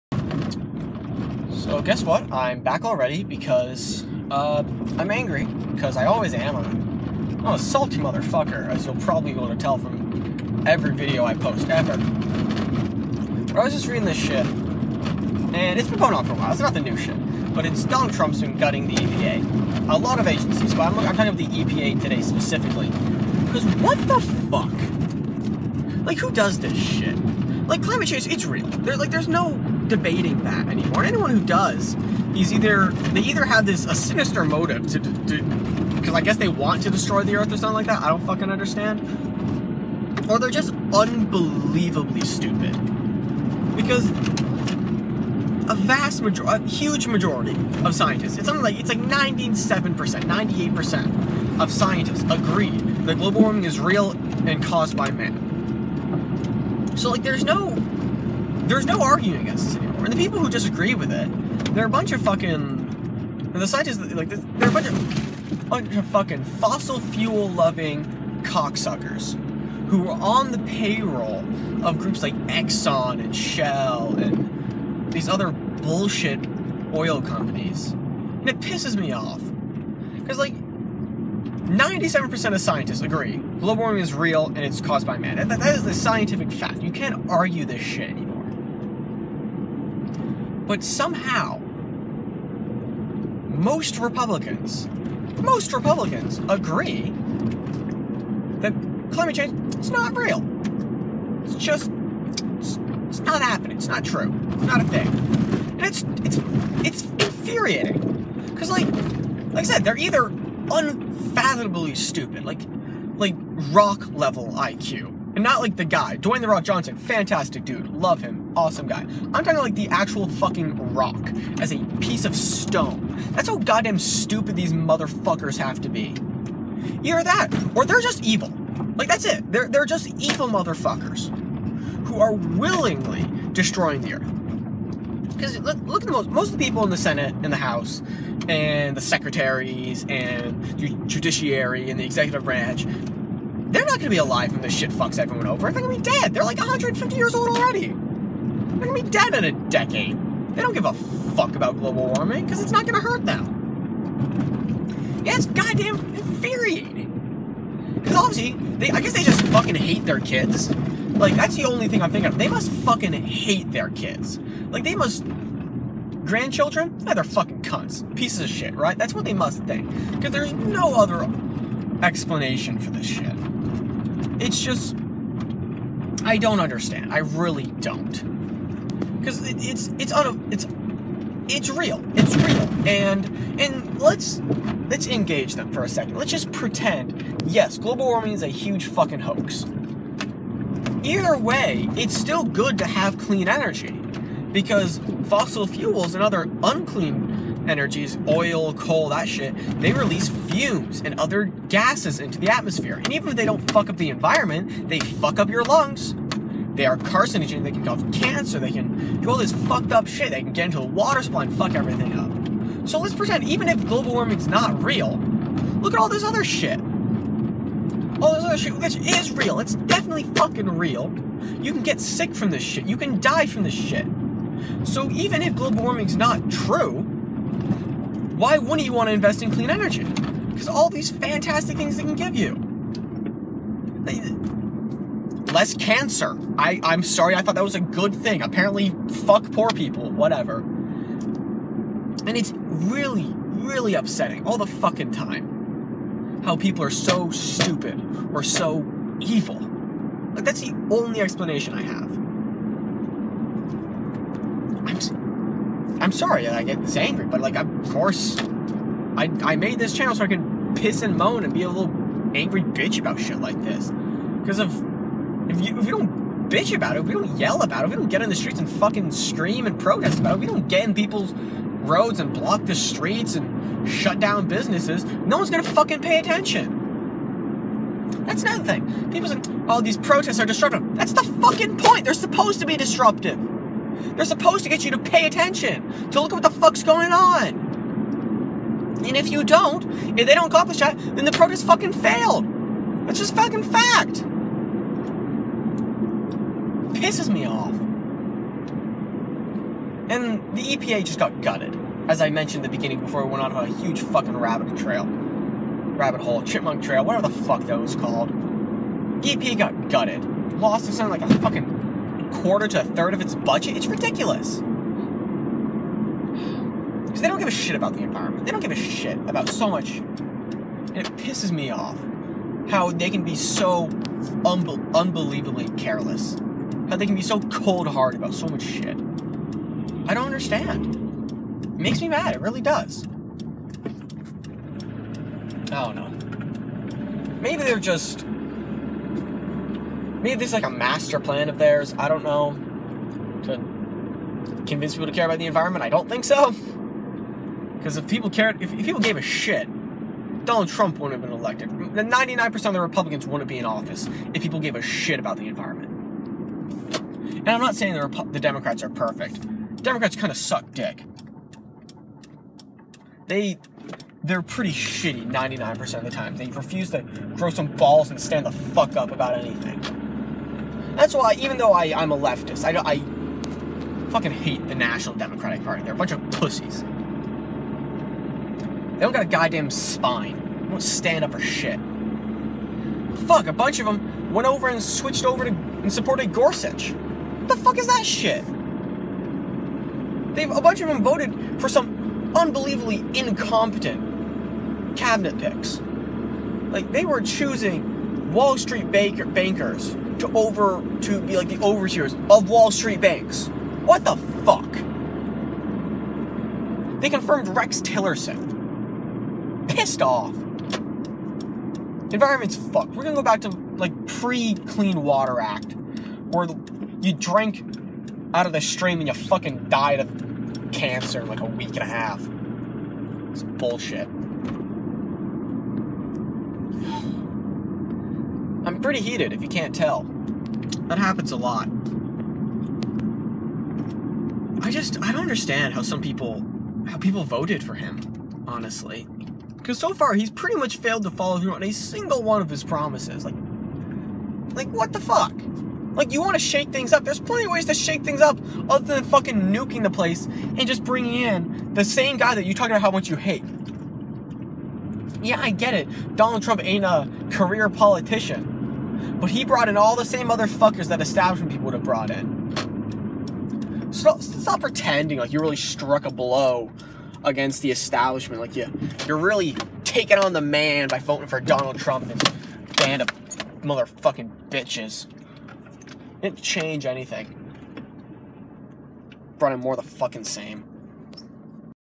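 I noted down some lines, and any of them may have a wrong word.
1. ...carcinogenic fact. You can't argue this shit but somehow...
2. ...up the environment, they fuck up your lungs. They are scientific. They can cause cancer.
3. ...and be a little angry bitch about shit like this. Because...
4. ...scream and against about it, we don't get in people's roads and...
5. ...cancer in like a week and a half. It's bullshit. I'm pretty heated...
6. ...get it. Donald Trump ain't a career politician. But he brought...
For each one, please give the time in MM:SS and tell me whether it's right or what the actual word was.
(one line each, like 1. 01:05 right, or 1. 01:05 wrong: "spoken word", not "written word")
1. 01:25 wrong: "scientific", not "carcinogenic"
2. 03:23 wrong: "carcinogenic", not "scientific"
3. 04:21 right
4. 04:29 wrong: "protest", not "against"
5. 07:00 right
6. 07:35 right.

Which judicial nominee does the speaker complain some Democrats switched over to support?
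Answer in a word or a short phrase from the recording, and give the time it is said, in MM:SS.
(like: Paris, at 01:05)
Gorsuch, at 06:26.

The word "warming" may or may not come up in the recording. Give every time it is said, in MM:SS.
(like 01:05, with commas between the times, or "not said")
00:53, 01:23, 02:32, 03:08, 03:34, 03:45.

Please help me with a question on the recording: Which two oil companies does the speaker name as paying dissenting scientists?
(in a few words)
Exxon and Shell.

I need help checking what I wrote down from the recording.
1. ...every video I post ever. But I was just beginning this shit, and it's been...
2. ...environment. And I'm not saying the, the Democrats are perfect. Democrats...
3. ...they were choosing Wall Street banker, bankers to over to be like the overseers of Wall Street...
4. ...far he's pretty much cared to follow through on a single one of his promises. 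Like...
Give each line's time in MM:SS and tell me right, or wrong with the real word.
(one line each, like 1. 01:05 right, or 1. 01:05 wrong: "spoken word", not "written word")
1. 00:10 wrong: "reading", not "beginning"
2. 05:55 right
3. 06:36 right
4. 07:19 wrong: "failed", not "cared".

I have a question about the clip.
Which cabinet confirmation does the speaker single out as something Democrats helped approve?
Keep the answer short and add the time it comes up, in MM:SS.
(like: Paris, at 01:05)
Rex Tillerson, at 06:47.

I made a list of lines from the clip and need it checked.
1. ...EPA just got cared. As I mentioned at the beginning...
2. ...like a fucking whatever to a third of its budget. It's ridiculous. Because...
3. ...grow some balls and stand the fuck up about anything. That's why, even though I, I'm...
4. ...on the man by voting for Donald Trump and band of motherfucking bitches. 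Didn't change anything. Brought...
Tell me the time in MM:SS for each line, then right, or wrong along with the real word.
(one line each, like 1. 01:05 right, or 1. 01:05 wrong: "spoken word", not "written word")
1. 05:00 wrong: "gutted", not "cared"
2. 05:11 wrong: "quarter", not "whatever"
3. 06:07 right
4. 07:50 right.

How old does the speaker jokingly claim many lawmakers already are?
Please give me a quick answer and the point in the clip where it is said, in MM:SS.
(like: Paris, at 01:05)
150, at 02:26.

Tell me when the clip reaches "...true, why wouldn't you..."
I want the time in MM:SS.
03:46.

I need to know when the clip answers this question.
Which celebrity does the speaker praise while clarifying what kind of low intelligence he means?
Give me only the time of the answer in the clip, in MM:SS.
01:56.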